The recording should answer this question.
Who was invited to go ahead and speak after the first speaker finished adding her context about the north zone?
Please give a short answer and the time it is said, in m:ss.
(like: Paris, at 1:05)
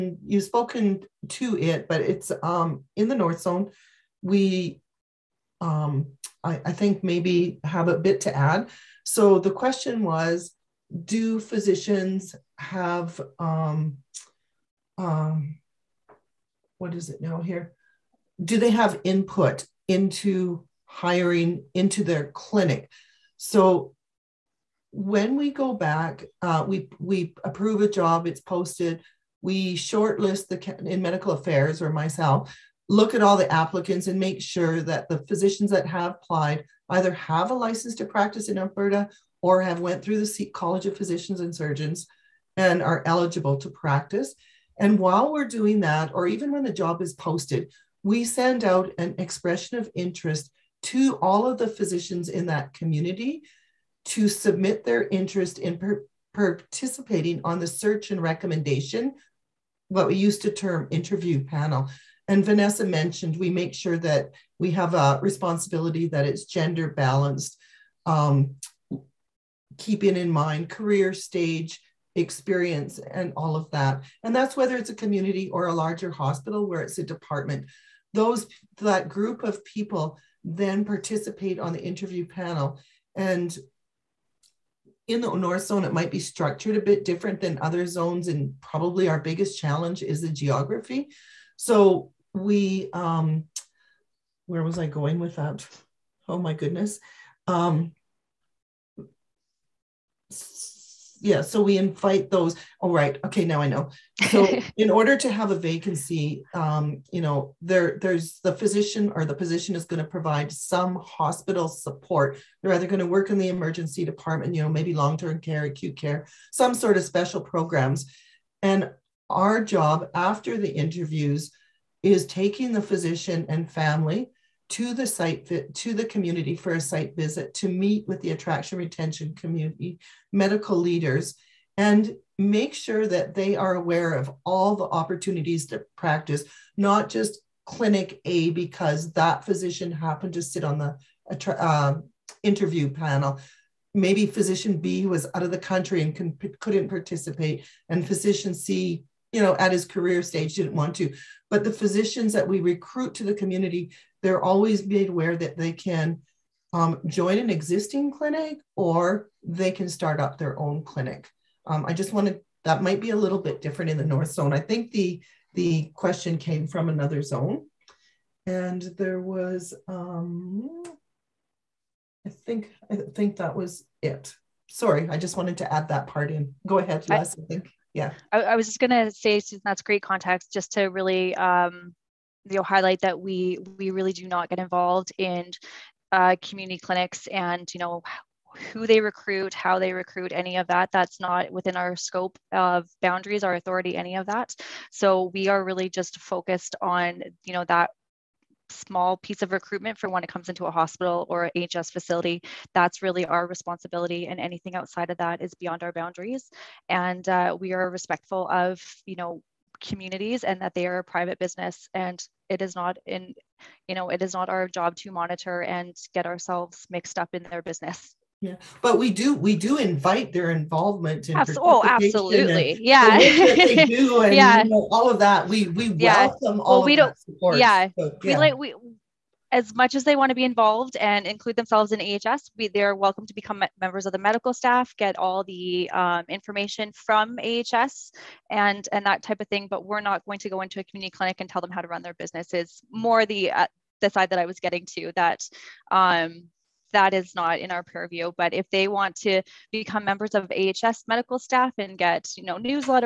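Les, at 2:57.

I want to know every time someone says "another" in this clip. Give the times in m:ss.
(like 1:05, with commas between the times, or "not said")
2:46.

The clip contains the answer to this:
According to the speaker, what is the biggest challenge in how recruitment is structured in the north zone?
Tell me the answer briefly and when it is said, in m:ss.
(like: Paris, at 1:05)
geography, at 1:30.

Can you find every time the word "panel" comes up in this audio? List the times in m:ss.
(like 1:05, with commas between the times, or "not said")
1:01, 1:22, 2:22.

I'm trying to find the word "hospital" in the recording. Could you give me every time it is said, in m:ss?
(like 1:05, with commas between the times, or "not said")
1:16, 1:50, 3:20.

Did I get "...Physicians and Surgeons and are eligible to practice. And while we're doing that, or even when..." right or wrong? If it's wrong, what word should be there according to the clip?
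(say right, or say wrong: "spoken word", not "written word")
right.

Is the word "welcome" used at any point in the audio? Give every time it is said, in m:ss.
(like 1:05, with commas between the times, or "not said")
3:45, 3:52.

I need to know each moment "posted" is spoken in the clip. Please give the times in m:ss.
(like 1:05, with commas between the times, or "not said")
0:28, 0:47.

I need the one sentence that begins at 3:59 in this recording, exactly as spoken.
But we're not going to go into a community clinic and tell them how to run their business.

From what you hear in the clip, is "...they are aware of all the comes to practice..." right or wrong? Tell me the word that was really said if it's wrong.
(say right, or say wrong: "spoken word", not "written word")
wrong: "opportunities", not "comes".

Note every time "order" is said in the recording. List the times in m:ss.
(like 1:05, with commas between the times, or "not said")
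1:44.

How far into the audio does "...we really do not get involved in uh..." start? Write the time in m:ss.
3:03.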